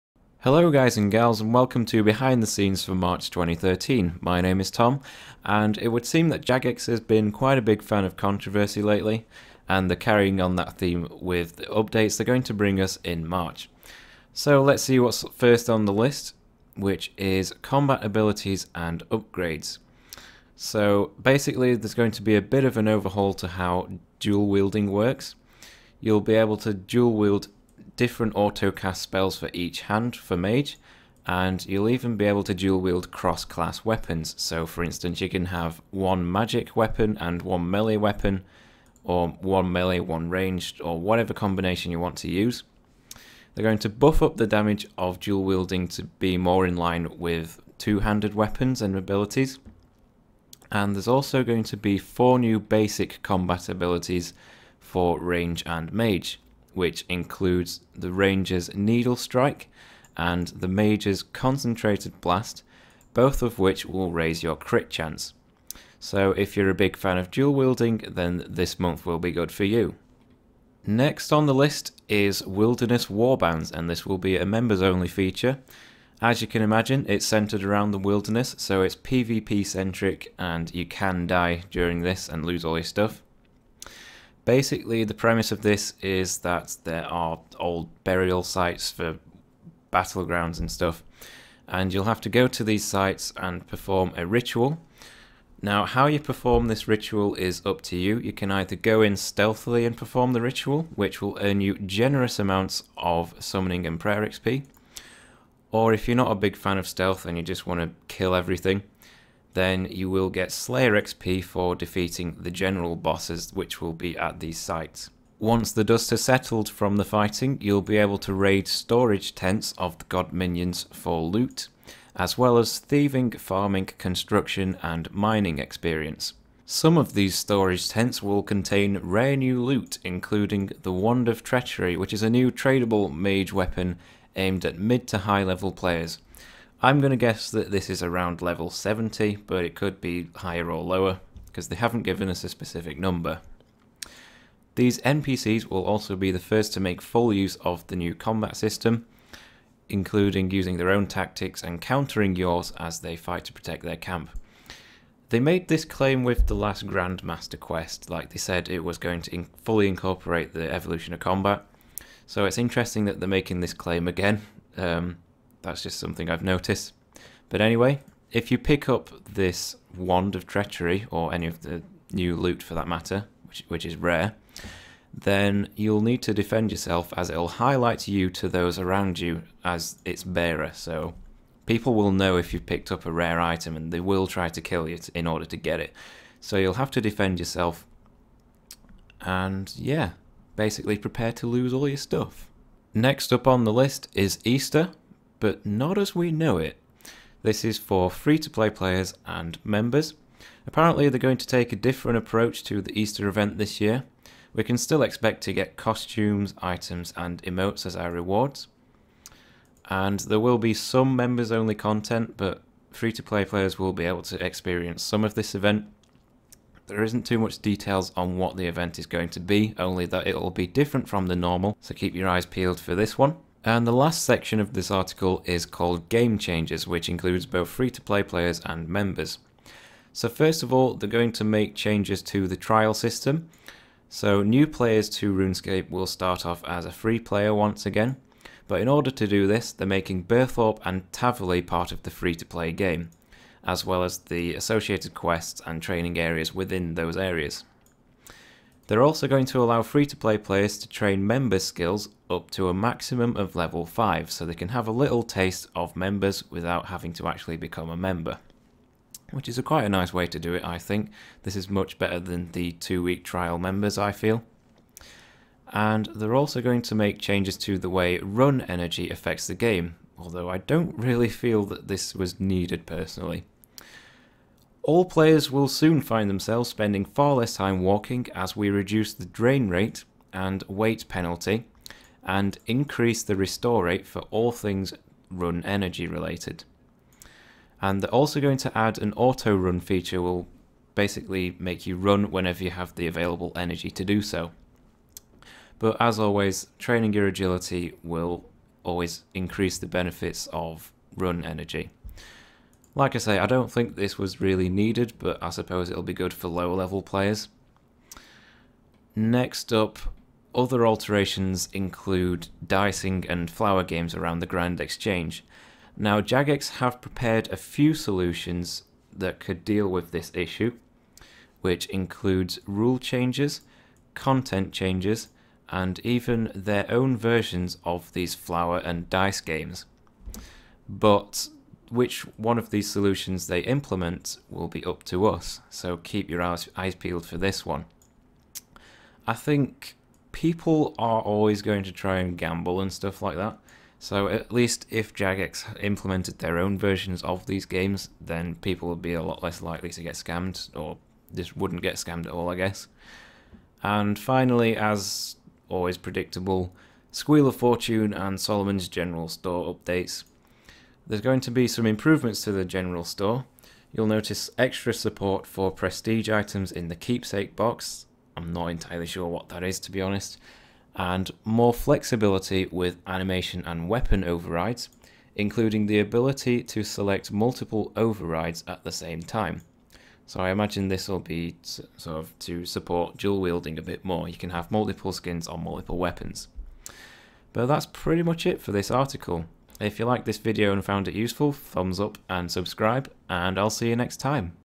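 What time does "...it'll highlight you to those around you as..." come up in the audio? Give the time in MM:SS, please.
02:57.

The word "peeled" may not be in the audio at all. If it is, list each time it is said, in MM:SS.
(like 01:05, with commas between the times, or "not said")
03:42, 05:36.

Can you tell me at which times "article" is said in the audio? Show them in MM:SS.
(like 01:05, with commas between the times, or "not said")
03:44, 06:28.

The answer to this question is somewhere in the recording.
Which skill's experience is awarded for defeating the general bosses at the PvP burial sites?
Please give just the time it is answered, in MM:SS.
01:50.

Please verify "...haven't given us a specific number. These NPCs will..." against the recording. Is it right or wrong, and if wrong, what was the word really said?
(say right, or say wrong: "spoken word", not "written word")
right.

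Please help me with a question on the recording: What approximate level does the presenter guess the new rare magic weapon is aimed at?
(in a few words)
70.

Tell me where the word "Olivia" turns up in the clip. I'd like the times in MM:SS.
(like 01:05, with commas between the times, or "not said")
not said.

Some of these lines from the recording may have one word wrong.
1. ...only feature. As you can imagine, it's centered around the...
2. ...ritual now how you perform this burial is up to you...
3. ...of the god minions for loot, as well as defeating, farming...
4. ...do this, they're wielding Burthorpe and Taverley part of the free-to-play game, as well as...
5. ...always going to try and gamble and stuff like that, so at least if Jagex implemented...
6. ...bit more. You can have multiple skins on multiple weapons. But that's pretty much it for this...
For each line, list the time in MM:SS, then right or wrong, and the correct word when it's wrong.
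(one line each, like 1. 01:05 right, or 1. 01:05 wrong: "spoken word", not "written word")
1. 01:14 right
2. 01:34 wrong: "ritual", not "burial"
3. 01:59 wrong: "thieving", not "defeating"
4. 03:59 wrong: "making", not "wielding"
5. 05:41 right
6. 06:23 right.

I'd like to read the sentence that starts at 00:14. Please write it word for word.
So let's see what's first on the list which is combat abilities and upgrades.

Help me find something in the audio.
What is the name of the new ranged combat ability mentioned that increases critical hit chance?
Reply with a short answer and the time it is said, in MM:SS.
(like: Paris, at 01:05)
Needle Strike, at 00:58.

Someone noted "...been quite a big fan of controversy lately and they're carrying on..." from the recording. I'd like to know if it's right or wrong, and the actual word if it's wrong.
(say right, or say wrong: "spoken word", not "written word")
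right.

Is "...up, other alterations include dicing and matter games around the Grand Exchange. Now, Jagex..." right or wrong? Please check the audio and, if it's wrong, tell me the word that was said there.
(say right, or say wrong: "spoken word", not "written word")
wrong: "flower", not "matter".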